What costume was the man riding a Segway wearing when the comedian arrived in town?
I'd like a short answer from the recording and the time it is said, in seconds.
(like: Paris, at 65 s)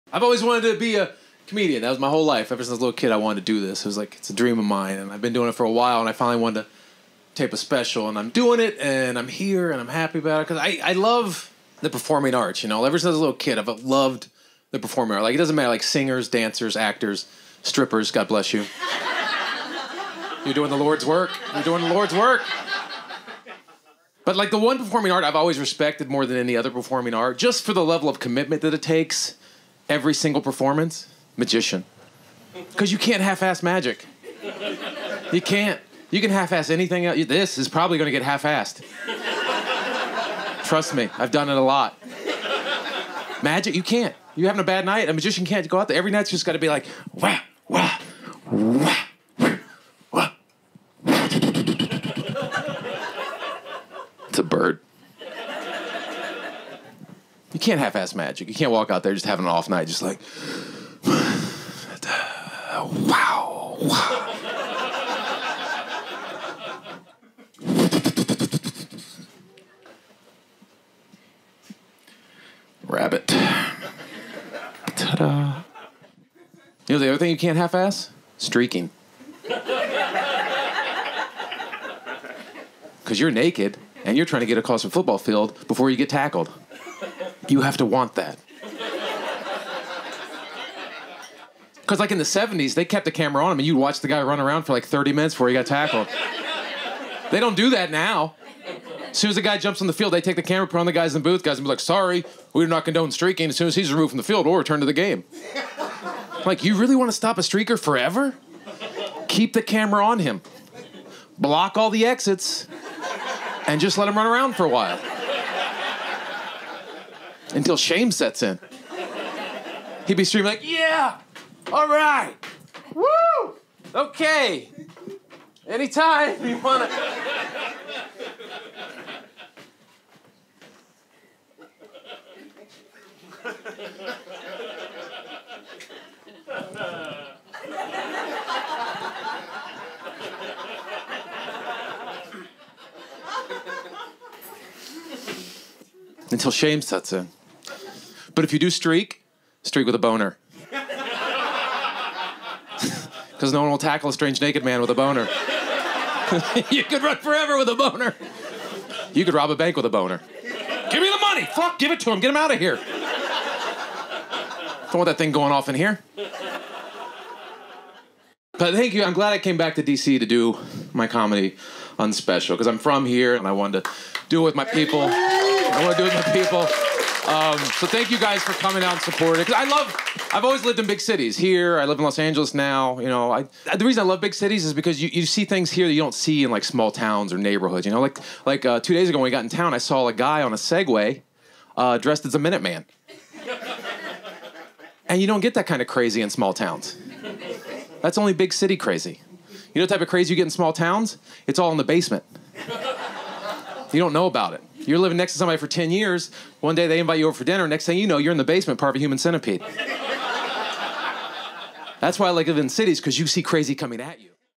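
Minuteman, at 192 s.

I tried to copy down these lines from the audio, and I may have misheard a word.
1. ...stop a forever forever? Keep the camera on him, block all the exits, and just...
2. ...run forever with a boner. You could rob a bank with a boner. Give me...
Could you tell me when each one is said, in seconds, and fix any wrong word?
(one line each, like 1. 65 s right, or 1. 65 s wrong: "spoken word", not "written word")
1. 107 s wrong: "streaker", not "forever"
2. 157 s right.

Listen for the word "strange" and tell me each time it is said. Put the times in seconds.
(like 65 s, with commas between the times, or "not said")
154 s.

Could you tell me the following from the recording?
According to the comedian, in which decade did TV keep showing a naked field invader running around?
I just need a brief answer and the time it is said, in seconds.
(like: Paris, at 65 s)
The 70s, at 92 s.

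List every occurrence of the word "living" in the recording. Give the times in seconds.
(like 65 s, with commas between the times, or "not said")
204 s, 212 s.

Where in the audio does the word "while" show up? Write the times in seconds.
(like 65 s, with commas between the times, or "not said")
5 s, 114 s.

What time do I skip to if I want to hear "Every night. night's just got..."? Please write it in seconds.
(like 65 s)
45 s.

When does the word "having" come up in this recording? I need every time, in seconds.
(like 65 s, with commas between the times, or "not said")
44 s, 59 s.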